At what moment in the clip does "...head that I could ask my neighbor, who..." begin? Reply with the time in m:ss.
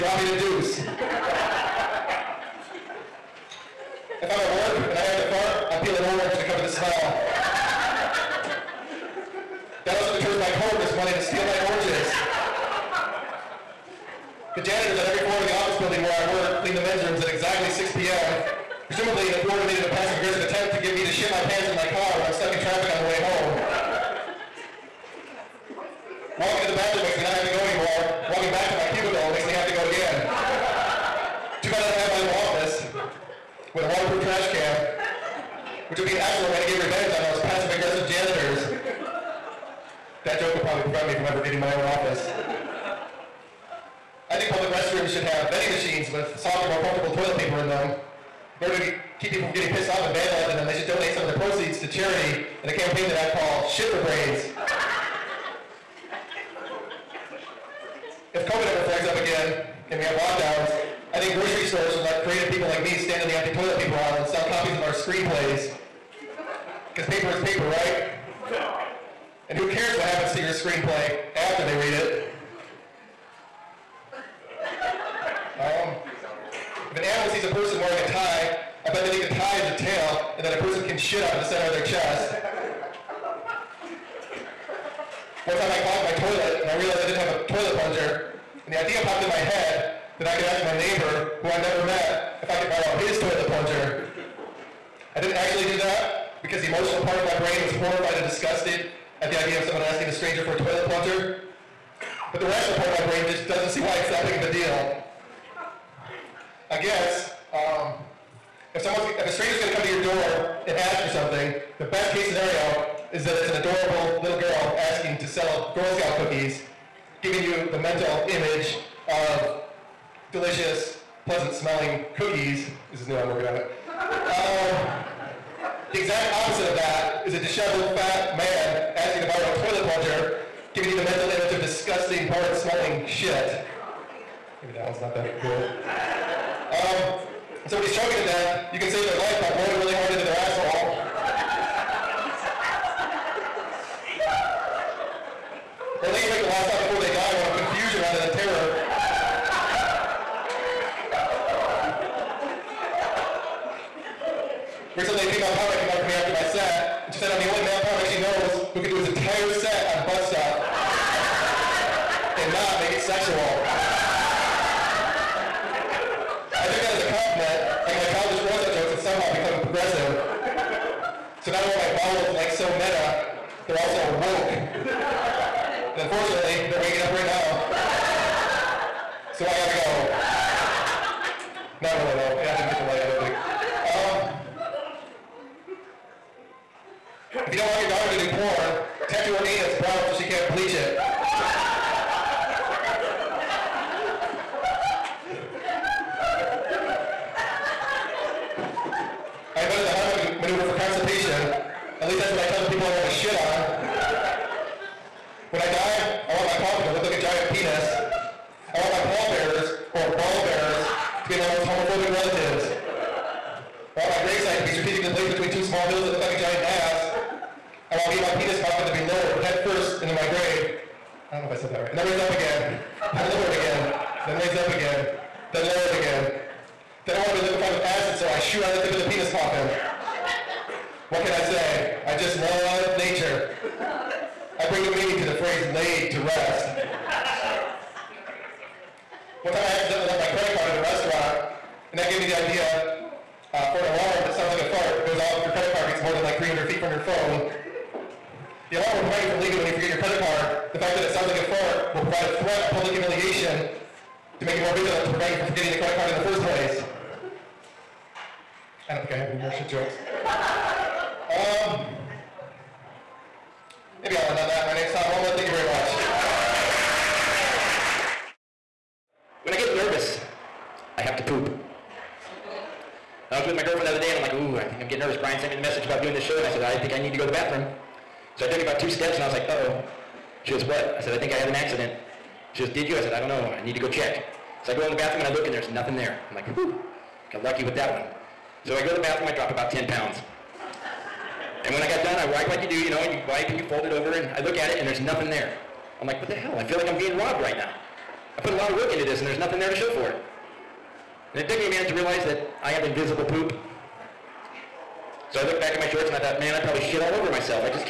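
1:29.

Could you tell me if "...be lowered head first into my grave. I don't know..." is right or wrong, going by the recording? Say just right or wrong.
right.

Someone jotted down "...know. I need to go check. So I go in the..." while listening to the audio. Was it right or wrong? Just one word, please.
right.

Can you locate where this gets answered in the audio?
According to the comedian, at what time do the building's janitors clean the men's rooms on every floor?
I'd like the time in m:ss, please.
0:17.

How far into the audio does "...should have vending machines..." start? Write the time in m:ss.
0:45.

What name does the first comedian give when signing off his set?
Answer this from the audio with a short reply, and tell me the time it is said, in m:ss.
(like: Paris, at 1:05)
Tom Olma, at 4:24.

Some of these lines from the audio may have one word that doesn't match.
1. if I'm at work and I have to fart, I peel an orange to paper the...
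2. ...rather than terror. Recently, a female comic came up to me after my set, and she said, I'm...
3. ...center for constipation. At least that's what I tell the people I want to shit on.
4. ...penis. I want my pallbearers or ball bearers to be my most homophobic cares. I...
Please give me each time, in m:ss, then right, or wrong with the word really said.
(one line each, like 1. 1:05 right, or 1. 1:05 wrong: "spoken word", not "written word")
1. 0:00 wrong: "cover", not "paper"
2. 2:28 right
3. 3:20 wrong: "maneuver", not "center"
4. 3:27 wrong: "relatives", not "cares".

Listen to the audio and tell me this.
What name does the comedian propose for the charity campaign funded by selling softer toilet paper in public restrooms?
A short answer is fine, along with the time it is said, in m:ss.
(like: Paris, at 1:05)
Shit for Brains, at 0:53.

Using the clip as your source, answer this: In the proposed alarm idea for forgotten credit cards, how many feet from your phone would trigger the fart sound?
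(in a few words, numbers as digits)
300.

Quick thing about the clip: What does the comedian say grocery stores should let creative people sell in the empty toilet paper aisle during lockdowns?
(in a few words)
screenplays.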